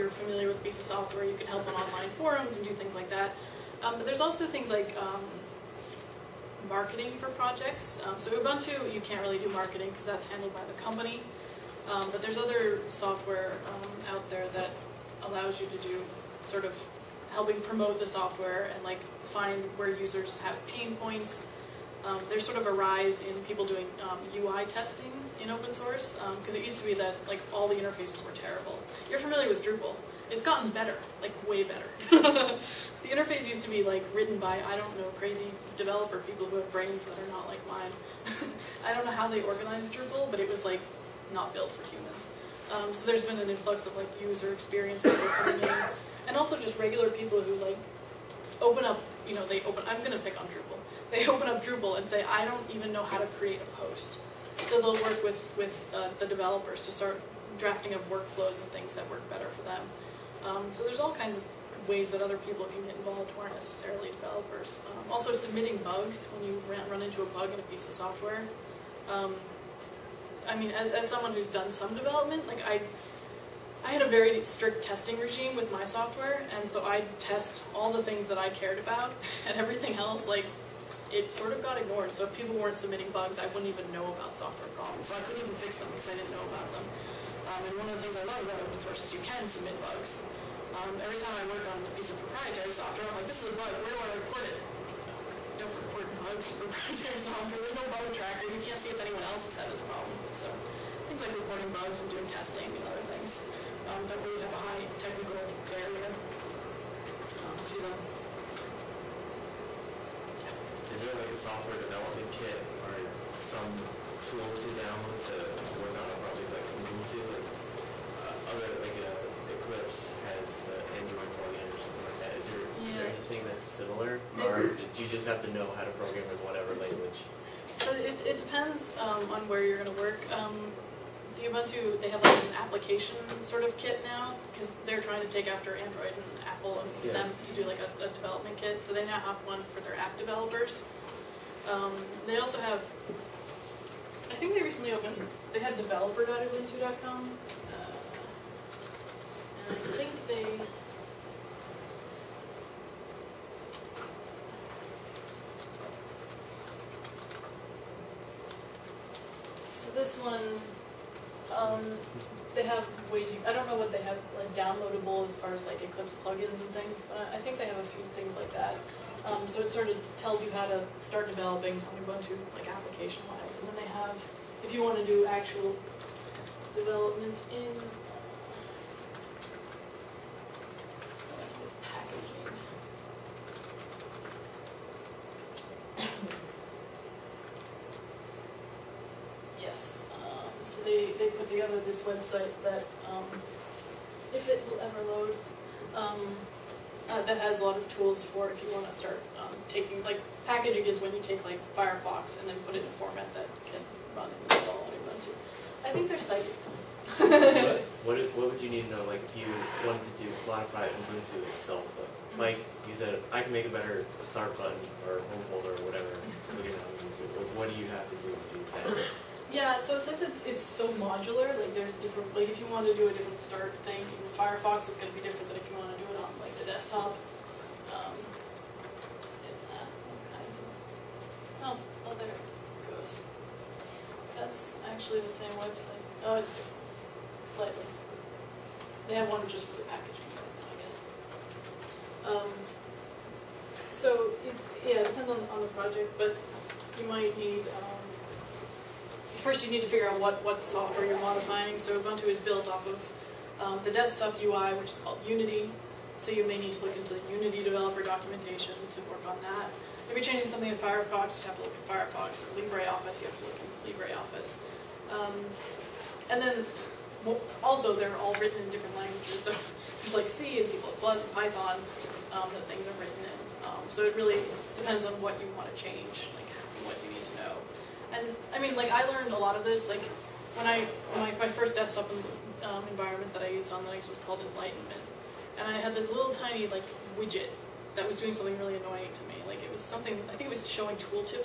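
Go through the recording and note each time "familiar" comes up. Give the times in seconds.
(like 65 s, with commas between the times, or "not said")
0 s, 29 s.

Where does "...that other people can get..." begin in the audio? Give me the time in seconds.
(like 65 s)
62 s.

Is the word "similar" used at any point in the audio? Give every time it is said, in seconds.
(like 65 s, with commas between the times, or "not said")
123 s.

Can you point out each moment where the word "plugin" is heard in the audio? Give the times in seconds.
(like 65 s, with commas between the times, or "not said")
121 s, 166 s.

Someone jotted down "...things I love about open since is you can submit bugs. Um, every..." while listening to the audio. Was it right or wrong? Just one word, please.
wrong.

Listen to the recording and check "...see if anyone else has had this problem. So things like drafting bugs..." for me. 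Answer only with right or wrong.
wrong.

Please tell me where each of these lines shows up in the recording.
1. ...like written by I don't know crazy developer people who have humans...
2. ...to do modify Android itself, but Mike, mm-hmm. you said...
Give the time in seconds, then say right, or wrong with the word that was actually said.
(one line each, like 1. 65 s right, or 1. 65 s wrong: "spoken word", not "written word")
1. 33 s wrong: "brains", not "humans"
2. 210 s wrong: "Ubuntu", not "Android".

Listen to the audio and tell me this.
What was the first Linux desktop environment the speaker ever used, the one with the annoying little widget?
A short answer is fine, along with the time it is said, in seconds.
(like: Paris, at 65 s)
Enlightenment, at 284 s.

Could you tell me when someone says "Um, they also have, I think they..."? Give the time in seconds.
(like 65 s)
141 s.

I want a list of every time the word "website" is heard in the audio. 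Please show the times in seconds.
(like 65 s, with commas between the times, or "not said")
192 s, 235 s.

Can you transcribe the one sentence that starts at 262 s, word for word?
Or LibreOffice, you have to look in LibreOffice.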